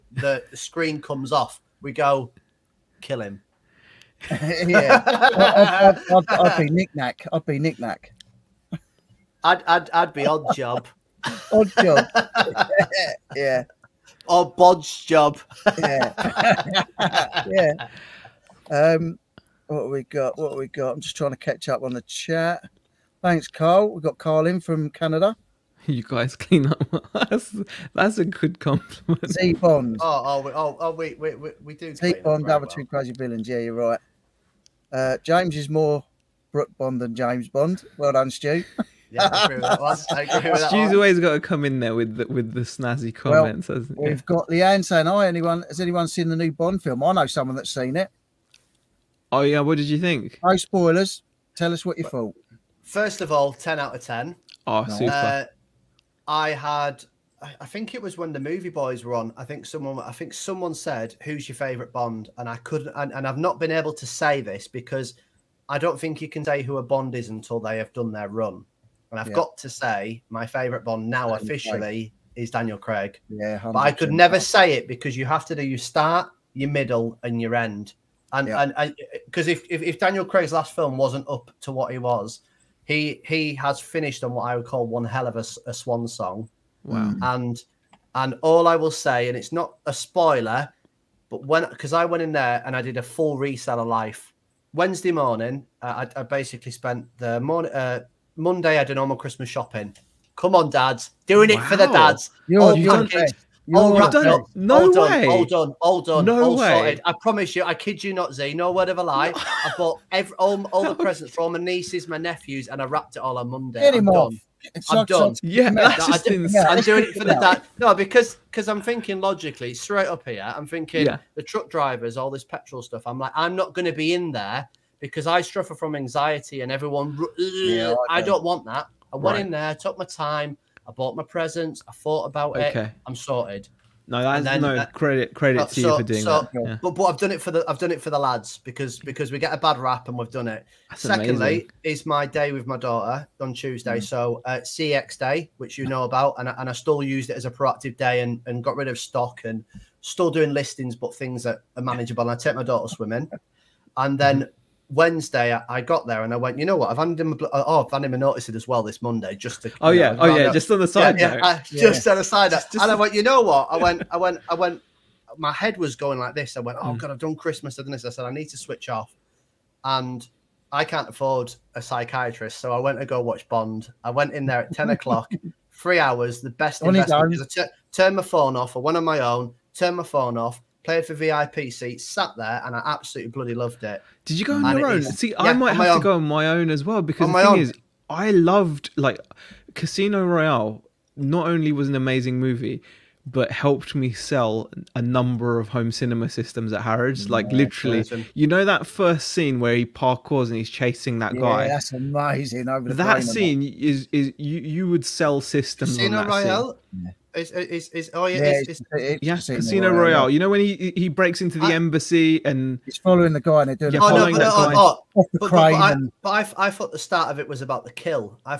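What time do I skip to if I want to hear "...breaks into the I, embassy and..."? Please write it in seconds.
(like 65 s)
211 s.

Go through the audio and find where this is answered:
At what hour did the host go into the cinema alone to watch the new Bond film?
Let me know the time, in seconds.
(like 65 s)
174 s.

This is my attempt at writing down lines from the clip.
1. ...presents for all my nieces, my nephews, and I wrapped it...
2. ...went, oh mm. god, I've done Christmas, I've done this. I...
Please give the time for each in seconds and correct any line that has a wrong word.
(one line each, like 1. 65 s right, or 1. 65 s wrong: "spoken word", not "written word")
1. 110 s right
2. 166 s right.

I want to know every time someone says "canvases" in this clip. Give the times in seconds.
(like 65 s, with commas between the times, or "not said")
not said.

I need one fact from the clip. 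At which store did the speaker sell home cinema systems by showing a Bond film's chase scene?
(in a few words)
Harrods.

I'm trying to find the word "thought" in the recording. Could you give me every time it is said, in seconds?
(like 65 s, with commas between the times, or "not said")
52 s, 131 s, 216 s.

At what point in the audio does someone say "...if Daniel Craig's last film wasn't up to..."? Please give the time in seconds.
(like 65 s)
79 s.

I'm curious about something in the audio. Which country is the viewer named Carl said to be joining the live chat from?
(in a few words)
Canada.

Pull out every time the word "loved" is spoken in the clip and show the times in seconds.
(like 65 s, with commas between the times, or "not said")
183 s, 188 s.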